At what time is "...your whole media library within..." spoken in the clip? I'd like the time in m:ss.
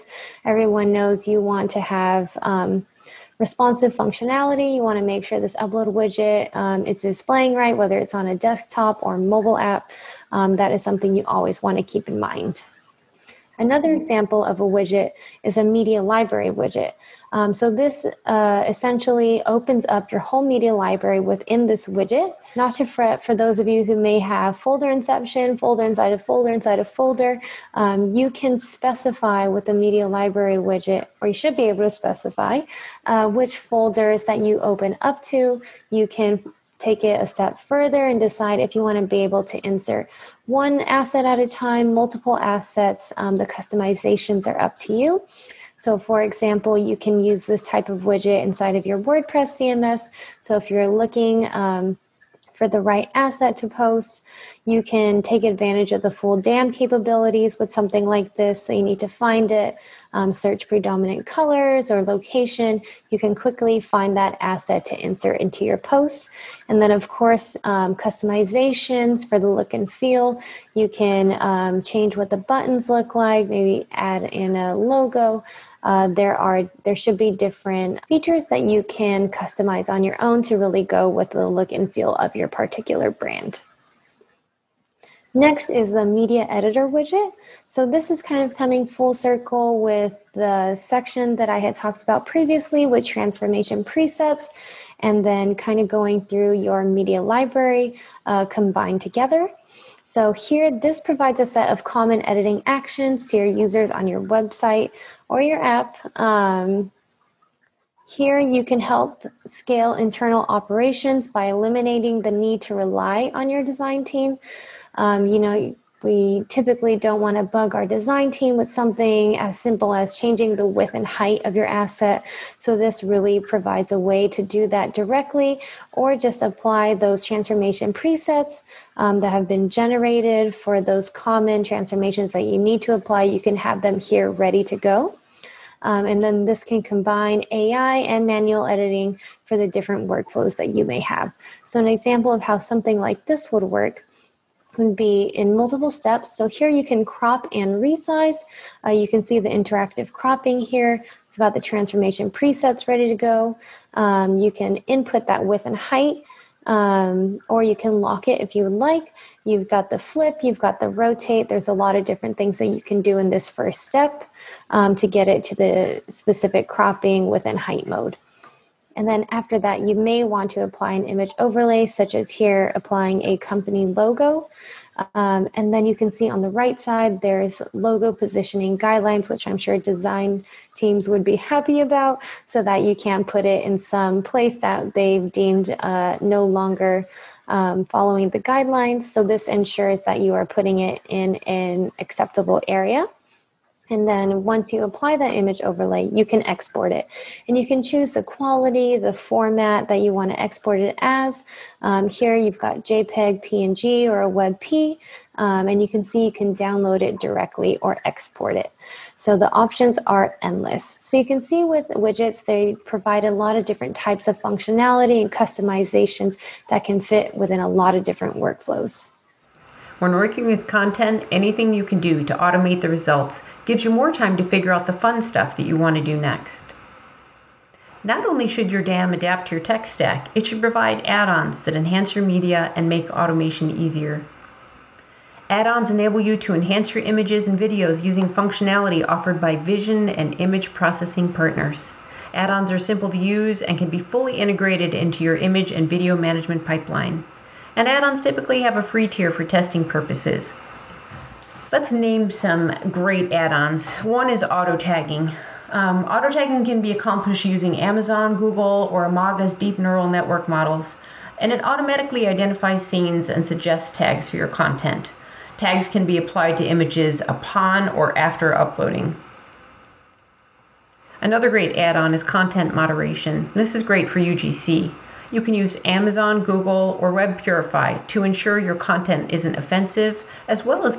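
0:20.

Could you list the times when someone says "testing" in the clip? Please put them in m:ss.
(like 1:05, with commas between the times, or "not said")
4:09.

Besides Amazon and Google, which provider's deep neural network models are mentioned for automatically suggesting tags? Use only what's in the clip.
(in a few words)
Imagga.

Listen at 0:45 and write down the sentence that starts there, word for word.
So, for example, you can use this type of widget inside of your WordPress CMS.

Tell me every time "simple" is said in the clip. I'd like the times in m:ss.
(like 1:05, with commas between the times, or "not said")
1:59, 4:02.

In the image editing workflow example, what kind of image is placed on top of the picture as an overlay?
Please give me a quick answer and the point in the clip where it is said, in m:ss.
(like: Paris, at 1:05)
Company logo, at 2:53.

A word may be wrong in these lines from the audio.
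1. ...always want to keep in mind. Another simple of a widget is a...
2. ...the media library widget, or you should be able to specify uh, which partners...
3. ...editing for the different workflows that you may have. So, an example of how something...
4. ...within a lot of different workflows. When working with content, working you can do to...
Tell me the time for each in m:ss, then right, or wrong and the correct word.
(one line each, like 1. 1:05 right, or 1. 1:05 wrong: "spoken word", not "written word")
1. 0:11 wrong: "example", not "simple"
2. 0:29 wrong: "folders", not "partners"
3. 2:18 right
4. 3:37 wrong: "anything", not "working".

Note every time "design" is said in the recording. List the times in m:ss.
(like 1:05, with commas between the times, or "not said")
1:53, 1:57, 2:59.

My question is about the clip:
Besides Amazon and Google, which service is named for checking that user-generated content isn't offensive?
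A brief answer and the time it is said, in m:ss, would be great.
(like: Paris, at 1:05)
WebPurify, at 4:37.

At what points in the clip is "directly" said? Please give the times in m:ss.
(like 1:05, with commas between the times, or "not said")
2:04, 3:27.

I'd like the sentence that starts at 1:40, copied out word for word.
So here, this provides a set of common editing actions to your users on your website or your app.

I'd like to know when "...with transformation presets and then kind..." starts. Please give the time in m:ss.
1:32.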